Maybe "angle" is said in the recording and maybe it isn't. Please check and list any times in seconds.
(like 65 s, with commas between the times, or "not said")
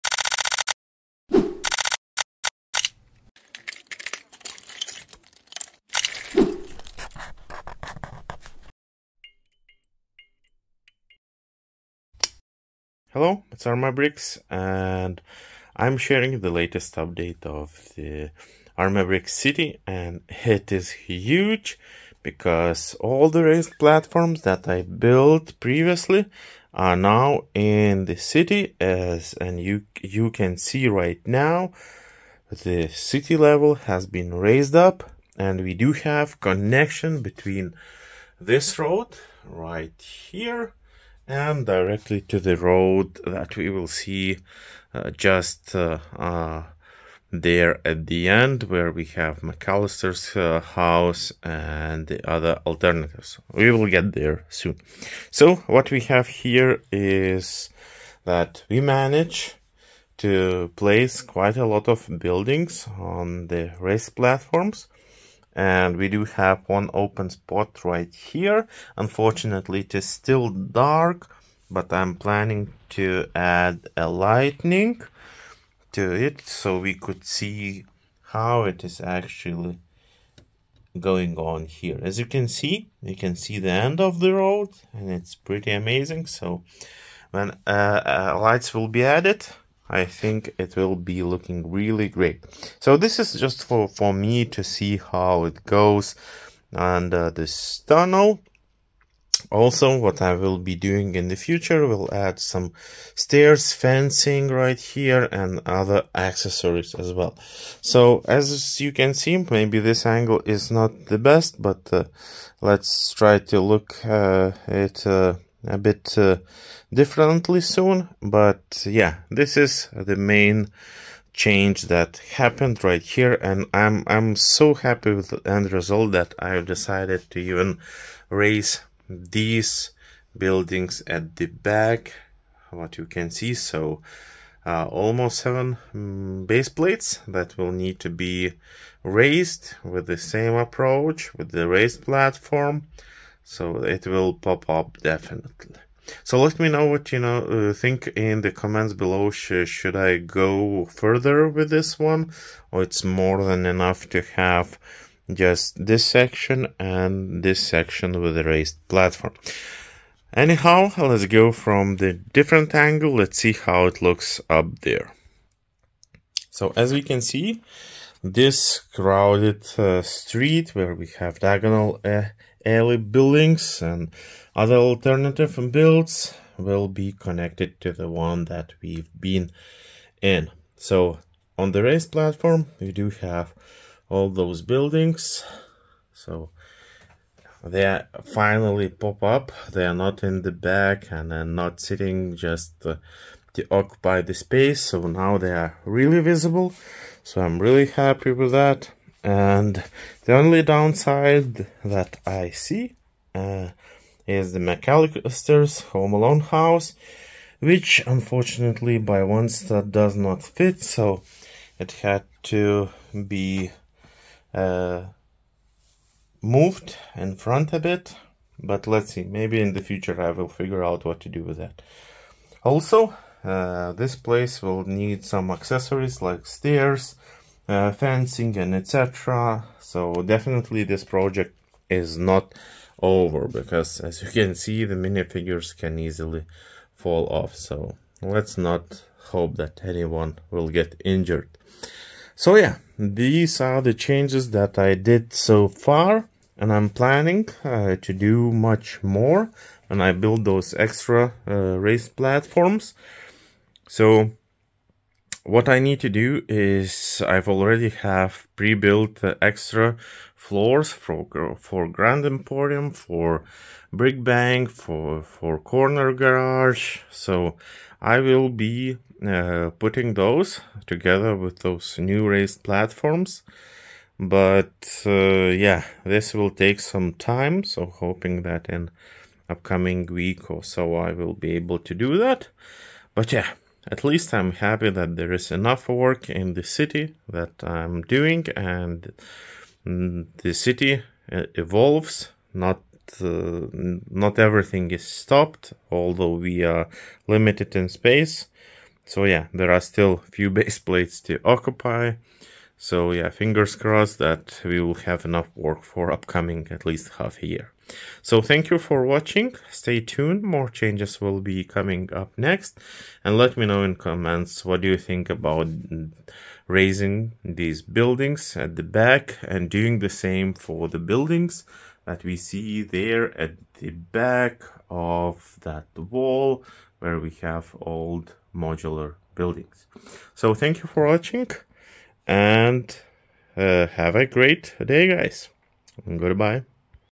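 110 s, 162 s.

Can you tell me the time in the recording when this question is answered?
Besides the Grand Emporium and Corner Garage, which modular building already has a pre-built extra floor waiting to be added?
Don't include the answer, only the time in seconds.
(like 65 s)
263 s.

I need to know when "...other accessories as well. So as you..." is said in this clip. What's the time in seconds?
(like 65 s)
105 s.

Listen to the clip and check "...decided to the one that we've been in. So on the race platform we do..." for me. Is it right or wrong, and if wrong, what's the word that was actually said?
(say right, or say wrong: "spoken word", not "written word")
wrong: "connected", not "decided".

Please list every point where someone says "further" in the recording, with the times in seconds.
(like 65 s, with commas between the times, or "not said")
150 s.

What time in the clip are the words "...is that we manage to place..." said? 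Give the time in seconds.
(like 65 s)
56 s.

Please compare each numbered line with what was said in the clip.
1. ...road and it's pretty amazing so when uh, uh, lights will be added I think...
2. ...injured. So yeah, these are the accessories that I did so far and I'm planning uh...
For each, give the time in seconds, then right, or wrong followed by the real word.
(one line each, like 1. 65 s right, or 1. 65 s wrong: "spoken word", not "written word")
1. 84 s right
2. 241 s wrong: "changes", not "accessories".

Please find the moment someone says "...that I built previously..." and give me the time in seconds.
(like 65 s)
24 s.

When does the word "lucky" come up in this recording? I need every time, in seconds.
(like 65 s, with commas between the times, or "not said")
not said.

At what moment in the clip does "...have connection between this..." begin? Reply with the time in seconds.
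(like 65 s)
35 s.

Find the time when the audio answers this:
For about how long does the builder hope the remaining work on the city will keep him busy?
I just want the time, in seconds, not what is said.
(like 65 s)
307 s.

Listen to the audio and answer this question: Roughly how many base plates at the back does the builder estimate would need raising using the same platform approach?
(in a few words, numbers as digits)
7.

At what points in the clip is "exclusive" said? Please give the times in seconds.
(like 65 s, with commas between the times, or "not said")
not said.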